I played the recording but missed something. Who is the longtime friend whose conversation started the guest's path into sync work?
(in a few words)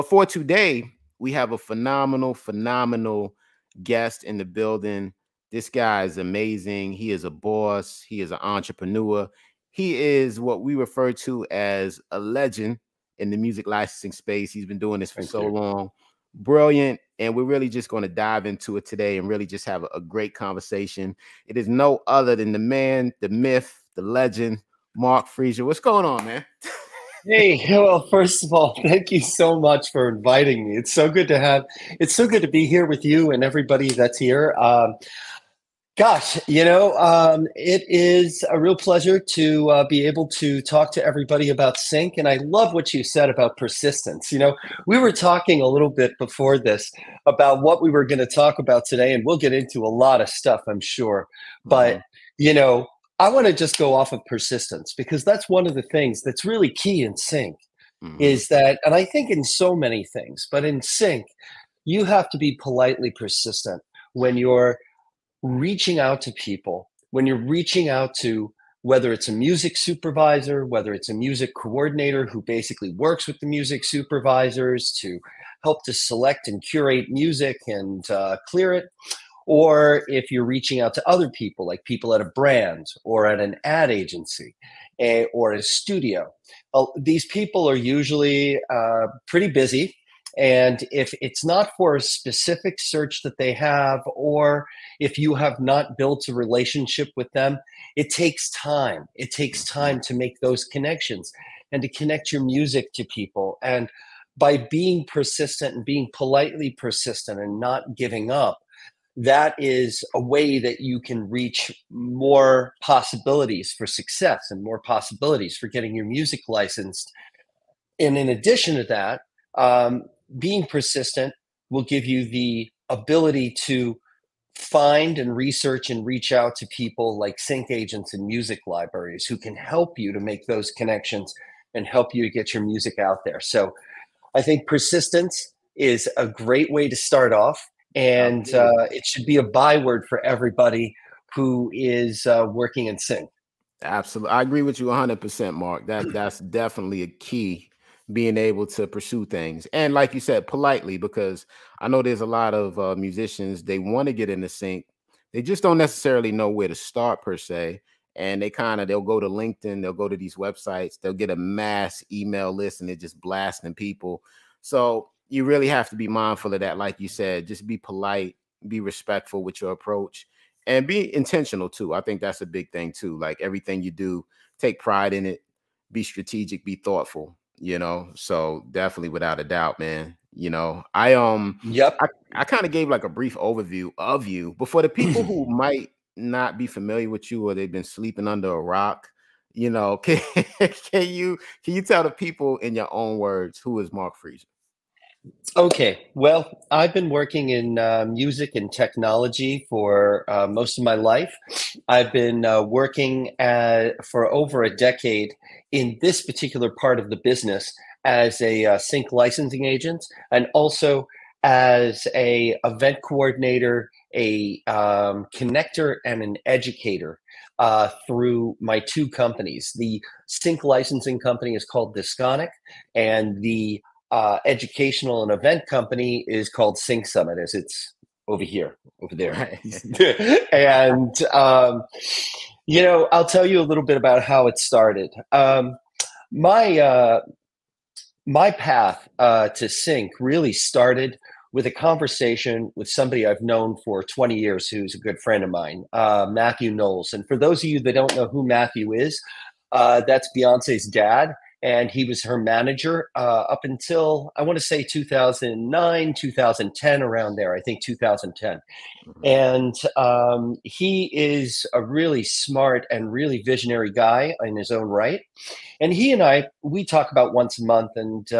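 Matthew Knowles.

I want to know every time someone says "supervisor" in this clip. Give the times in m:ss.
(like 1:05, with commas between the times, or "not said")
1:09, 1:13.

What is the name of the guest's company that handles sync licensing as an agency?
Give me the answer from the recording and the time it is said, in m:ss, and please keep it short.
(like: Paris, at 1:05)
Disconic, at 3:41.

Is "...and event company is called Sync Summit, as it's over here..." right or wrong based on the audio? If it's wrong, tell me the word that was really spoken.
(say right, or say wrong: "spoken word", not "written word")
right.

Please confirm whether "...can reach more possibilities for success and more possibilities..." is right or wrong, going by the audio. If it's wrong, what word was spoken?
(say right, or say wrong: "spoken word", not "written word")
right.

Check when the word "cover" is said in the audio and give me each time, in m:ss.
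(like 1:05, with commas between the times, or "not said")
not said.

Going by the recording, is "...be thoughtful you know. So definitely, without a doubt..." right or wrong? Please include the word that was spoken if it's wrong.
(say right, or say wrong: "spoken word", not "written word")
right.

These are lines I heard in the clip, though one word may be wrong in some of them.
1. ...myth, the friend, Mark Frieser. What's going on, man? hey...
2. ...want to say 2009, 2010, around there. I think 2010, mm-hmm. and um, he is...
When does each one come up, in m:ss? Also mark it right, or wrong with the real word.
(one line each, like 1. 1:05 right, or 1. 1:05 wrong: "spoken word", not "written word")
1. 0:23 wrong: "legend", not "friend"
2. 4:14 right.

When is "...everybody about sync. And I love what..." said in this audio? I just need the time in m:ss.
0:41.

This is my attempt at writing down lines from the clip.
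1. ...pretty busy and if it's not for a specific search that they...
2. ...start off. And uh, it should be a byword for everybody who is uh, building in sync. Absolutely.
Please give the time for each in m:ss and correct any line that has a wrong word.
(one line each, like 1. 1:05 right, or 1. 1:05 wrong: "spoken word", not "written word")
1. 1:29 right
2. 2:16 wrong: "working", not "building".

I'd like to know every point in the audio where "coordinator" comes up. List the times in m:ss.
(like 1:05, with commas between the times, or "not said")
1:11, 3:33.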